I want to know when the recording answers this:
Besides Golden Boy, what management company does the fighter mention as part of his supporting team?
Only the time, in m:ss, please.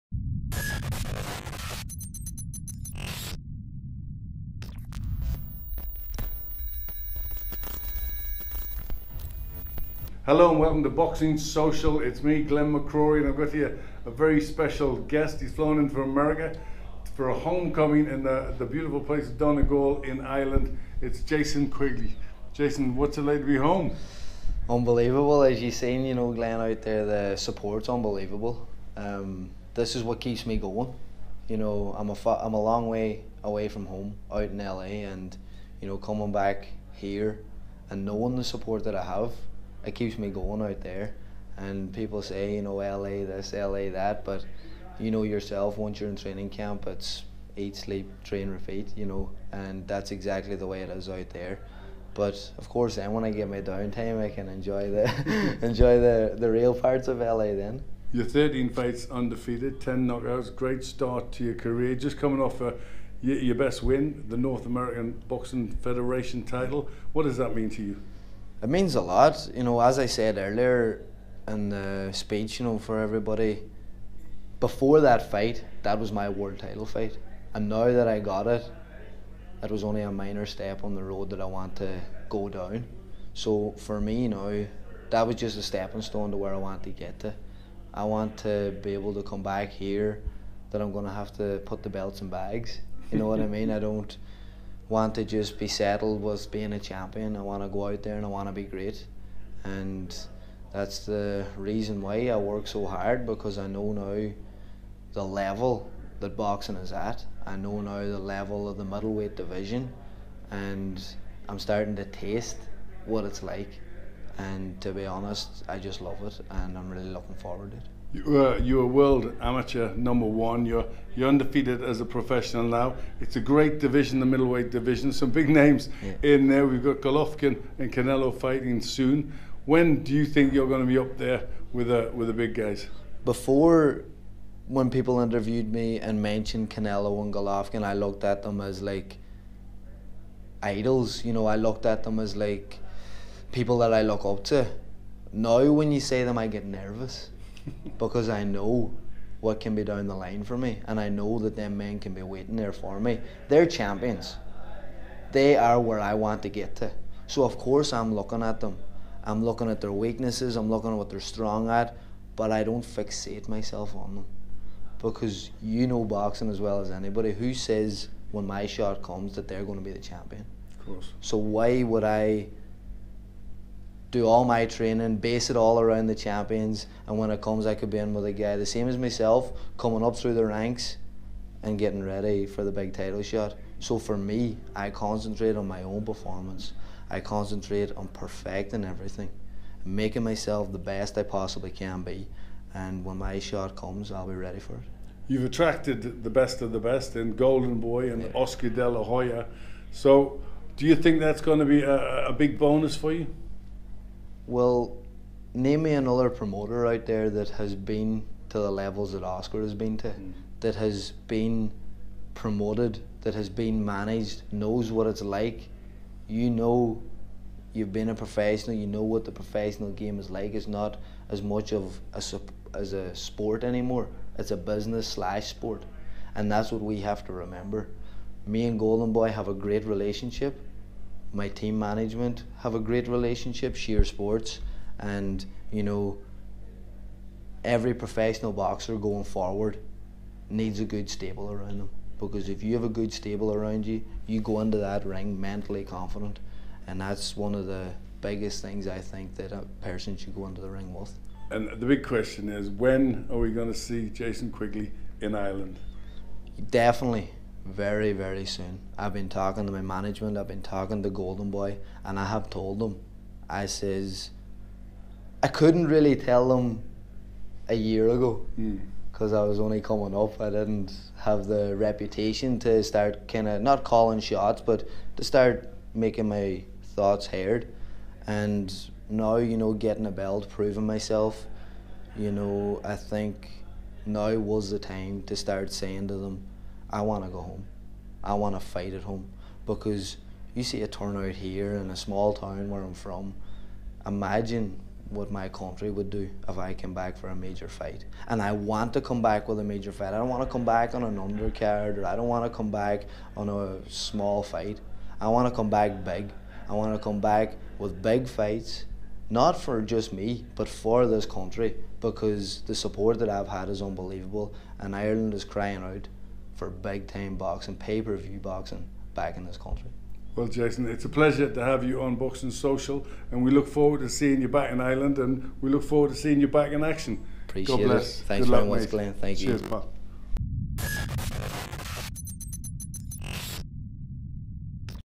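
3:53.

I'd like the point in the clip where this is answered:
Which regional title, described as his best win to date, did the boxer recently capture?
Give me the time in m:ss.
1:04.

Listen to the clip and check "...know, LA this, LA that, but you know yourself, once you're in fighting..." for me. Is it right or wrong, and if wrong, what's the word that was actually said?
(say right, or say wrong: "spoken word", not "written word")
wrong: "training", not "fighting".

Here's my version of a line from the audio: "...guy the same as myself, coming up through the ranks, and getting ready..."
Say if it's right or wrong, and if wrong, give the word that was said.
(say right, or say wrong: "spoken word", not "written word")
right.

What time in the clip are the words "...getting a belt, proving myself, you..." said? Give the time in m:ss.
4:39.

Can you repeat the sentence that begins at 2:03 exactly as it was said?
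It's a great division, the middleweight division.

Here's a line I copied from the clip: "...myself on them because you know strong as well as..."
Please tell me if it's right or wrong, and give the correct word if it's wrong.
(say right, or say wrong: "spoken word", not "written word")
wrong: "boxing", not "strong".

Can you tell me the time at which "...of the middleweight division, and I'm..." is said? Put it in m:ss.
1:48.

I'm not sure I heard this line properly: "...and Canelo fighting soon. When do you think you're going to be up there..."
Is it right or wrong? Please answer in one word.
right.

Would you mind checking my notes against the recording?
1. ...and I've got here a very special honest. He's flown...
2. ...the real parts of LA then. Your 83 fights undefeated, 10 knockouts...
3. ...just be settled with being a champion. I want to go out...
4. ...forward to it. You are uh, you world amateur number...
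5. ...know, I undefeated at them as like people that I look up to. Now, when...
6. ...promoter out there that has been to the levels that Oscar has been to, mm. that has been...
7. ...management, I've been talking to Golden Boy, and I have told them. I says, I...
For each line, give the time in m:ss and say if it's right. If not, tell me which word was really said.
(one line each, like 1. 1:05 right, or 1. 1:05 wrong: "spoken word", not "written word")
1. 0:13 wrong: "guest", not "honest"
2. 0:56 wrong: "13", not "83"
3. 1:35 right
4. 1:57 right
5. 2:21 wrong: "looked", not "undefeated"
6. 3:26 right
7. 4:19 right.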